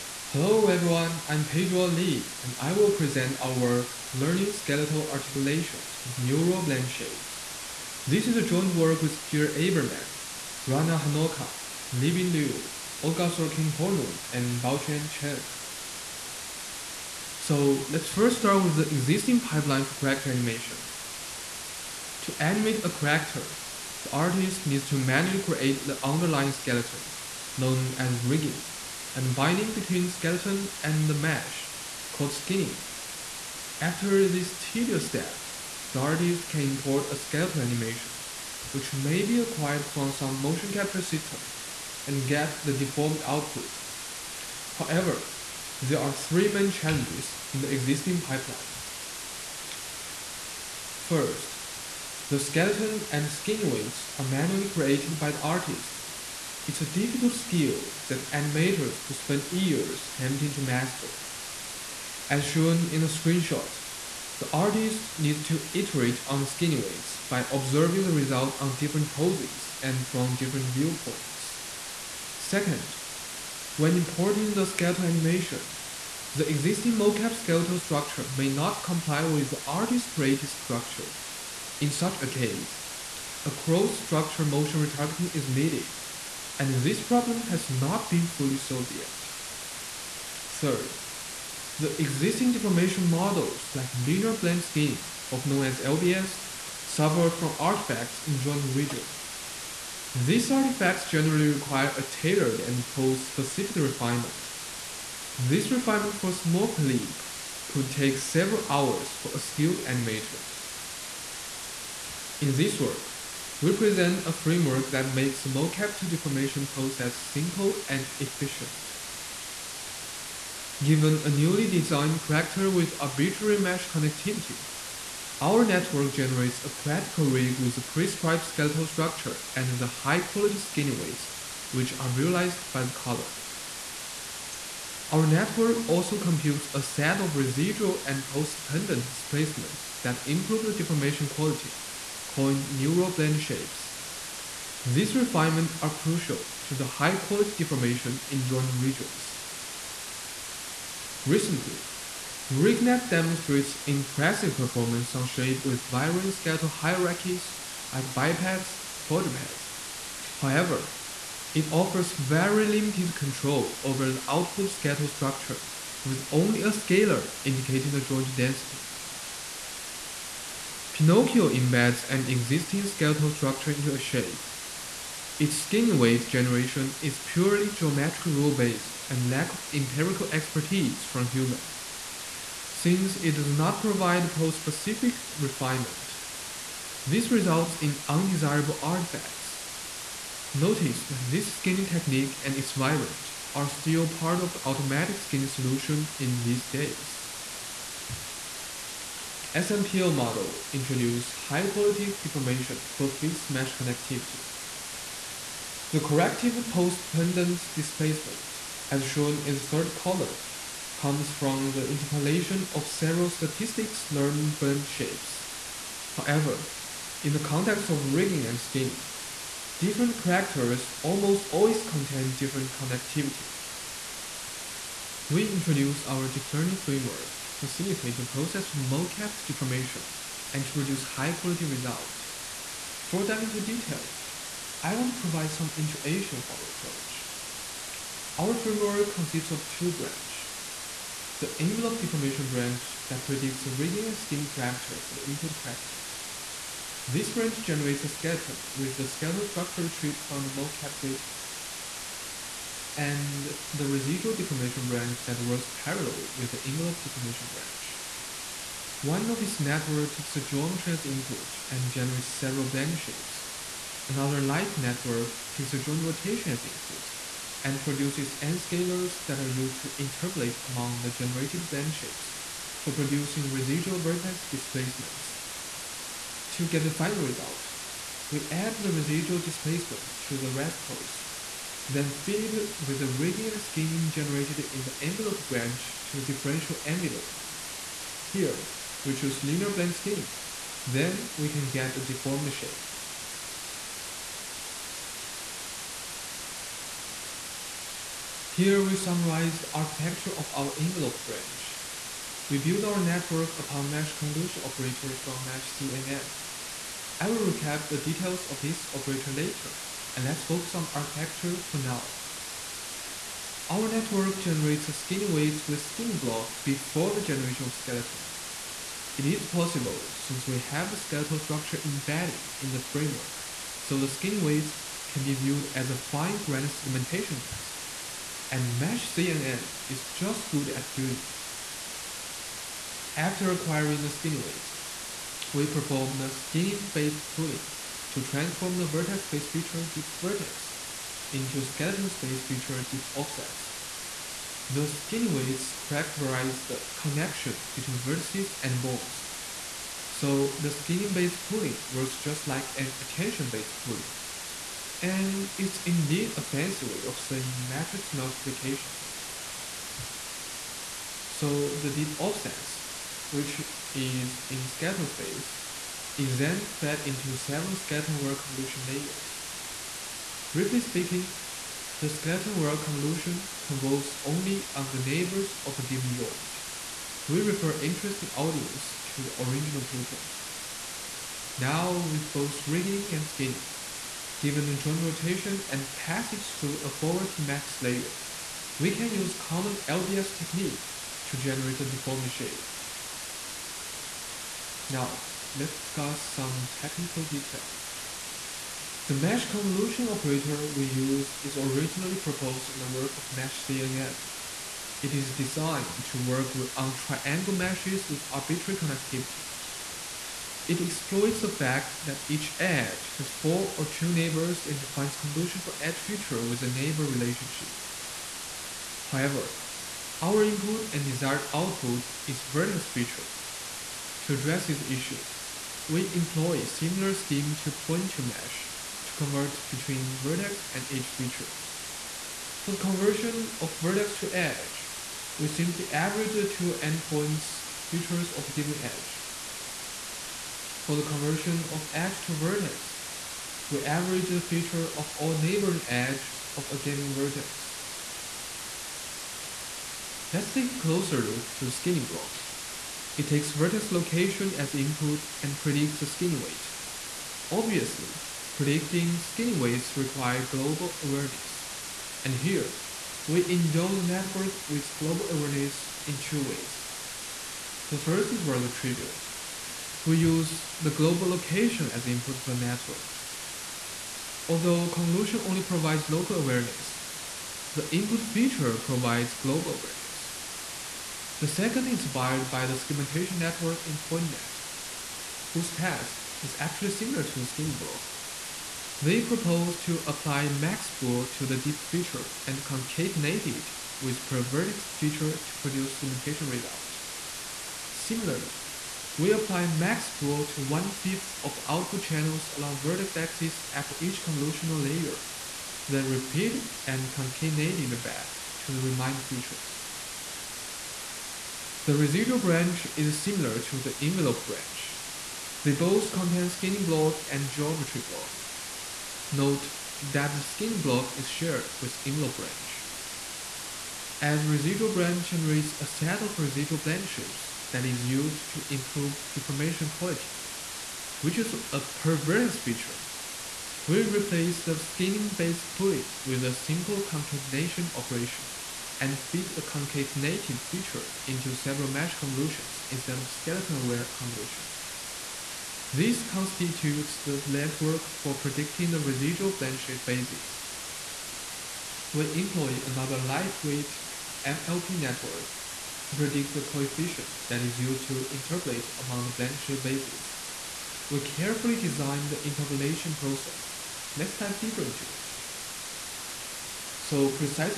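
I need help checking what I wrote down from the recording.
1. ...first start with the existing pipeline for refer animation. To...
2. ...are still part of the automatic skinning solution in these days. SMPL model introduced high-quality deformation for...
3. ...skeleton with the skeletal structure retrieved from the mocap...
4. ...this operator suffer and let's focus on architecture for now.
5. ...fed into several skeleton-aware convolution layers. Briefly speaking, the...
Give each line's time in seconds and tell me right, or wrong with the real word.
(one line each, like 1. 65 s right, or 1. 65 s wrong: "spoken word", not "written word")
1. 18 s wrong: "character", not "refer"
2. 193 s right
3. 248 s right
4. 308 s wrong: "later", not "suffer"
5. 366 s right.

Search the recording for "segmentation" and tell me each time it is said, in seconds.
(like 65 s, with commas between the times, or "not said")
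326 s, 482 s, 495 s.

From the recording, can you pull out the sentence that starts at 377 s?
We refer interesting audience to the original paper.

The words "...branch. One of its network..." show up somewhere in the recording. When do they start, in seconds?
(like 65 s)
257 s.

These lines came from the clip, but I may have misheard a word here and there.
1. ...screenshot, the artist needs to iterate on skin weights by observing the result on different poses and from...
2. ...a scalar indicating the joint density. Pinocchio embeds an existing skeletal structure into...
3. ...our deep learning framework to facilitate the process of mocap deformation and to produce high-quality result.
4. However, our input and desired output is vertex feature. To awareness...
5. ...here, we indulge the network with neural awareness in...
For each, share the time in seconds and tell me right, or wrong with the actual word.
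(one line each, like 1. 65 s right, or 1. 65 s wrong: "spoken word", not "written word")
1. 63 s right
2. 166 s right
3. 226 s right
4. 419 s wrong: "address", not "awareness"
5. 462 s wrong: "global", not "neural".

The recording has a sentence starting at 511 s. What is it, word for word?
The residual branch is similar to the envelope branch.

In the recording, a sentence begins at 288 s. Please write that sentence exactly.
Here, we choose linear blend skinning.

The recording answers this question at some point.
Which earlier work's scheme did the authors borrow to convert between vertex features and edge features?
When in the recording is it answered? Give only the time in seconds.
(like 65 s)
427 s.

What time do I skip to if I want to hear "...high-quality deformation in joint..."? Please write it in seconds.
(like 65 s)
146 s.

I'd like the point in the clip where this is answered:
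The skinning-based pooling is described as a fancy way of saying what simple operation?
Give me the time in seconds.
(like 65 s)
357 s.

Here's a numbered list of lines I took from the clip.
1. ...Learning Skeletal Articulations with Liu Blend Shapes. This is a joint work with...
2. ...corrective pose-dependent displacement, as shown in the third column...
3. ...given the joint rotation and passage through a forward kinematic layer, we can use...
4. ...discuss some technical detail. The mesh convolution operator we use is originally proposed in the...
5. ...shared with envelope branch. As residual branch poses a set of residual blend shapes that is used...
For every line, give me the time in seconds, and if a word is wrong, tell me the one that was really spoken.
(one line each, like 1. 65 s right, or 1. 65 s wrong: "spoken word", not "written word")
1. 4 s wrong: "Neural", not "Liu"
2. 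206 s right
3. 384 s right
4. 395 s right
5. 521 s wrong: "generates", not "poses".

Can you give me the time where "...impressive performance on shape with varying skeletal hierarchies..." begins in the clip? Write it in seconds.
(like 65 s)
153 s.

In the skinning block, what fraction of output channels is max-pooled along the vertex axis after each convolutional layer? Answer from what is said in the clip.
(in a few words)
one-fifth.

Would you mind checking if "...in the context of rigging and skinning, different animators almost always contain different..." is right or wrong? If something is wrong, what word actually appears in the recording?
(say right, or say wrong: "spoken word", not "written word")
wrong: "characters", not "animators".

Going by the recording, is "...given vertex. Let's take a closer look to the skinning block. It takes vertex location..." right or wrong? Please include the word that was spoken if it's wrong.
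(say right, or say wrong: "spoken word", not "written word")
right.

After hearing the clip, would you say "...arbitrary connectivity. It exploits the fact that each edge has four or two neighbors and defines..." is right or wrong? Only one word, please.
right.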